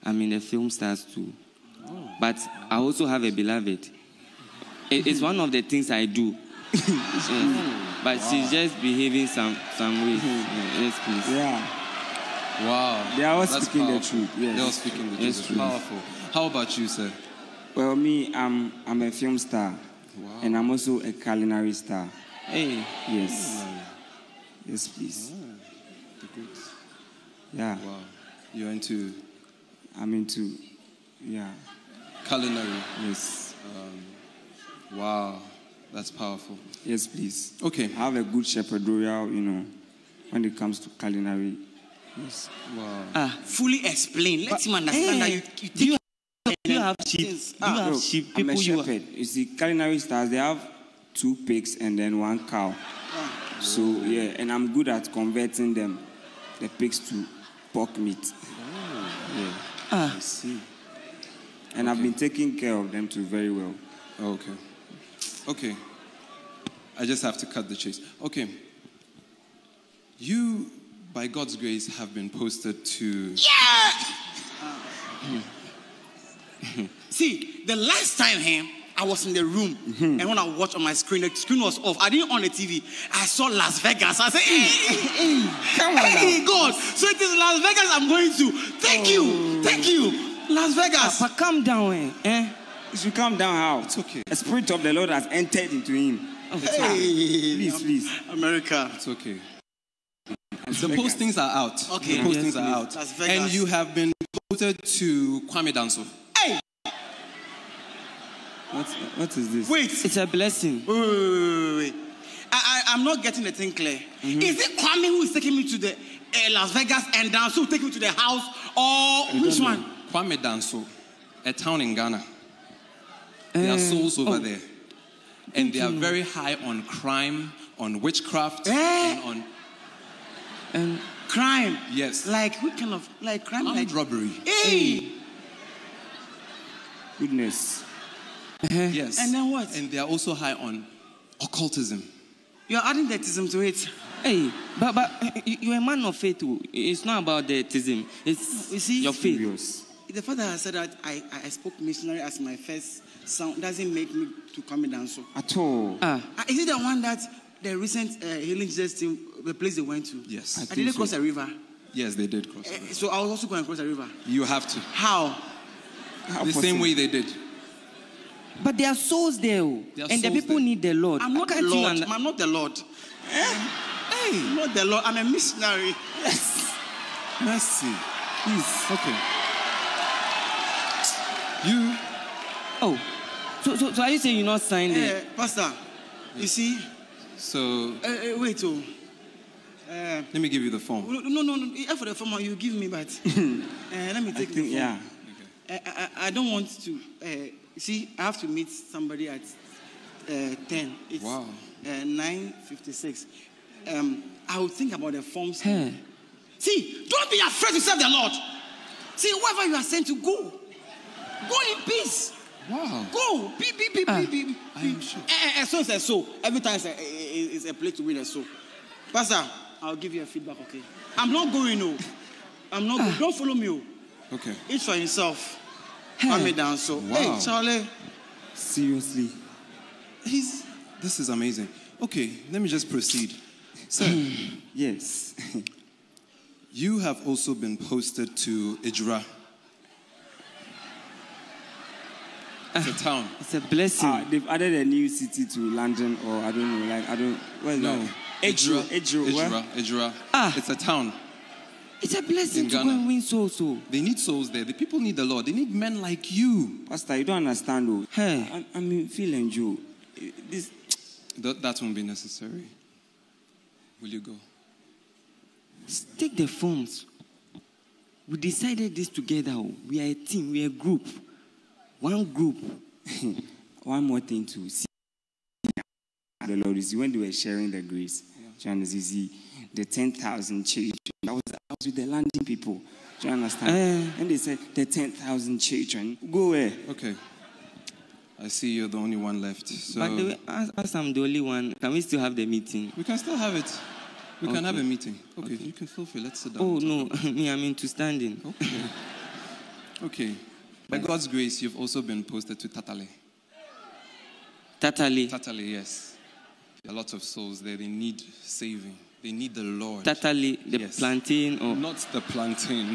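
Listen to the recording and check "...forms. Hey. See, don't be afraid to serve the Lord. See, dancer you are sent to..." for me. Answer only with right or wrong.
wrong.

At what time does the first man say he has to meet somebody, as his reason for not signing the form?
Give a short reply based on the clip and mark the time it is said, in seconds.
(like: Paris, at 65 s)
10, at 200 s.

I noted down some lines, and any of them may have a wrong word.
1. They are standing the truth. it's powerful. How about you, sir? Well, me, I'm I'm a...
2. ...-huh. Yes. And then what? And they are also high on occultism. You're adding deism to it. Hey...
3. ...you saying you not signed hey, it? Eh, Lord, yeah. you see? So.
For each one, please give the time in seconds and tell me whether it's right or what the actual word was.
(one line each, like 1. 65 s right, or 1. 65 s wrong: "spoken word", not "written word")
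1. 14 s wrong: "speaking", not "standing"
2. 138 s right
3. 184 s wrong: "Pastor", not "Lord".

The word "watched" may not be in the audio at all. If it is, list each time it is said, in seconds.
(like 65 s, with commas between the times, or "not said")
80 s.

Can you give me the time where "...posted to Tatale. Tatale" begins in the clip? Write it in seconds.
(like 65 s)
302 s.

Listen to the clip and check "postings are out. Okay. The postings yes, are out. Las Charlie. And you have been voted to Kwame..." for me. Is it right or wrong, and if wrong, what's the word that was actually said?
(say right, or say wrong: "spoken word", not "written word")
wrong: "Vegas", not "Charlie".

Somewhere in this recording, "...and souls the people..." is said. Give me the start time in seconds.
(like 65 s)
170 s.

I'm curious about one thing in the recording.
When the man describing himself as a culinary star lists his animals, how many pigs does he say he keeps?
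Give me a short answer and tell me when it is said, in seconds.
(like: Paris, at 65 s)
2, at 51 s.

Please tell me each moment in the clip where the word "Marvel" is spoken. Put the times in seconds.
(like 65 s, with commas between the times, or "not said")
not said.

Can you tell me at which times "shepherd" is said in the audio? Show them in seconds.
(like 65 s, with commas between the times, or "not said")
38 s, 48 s.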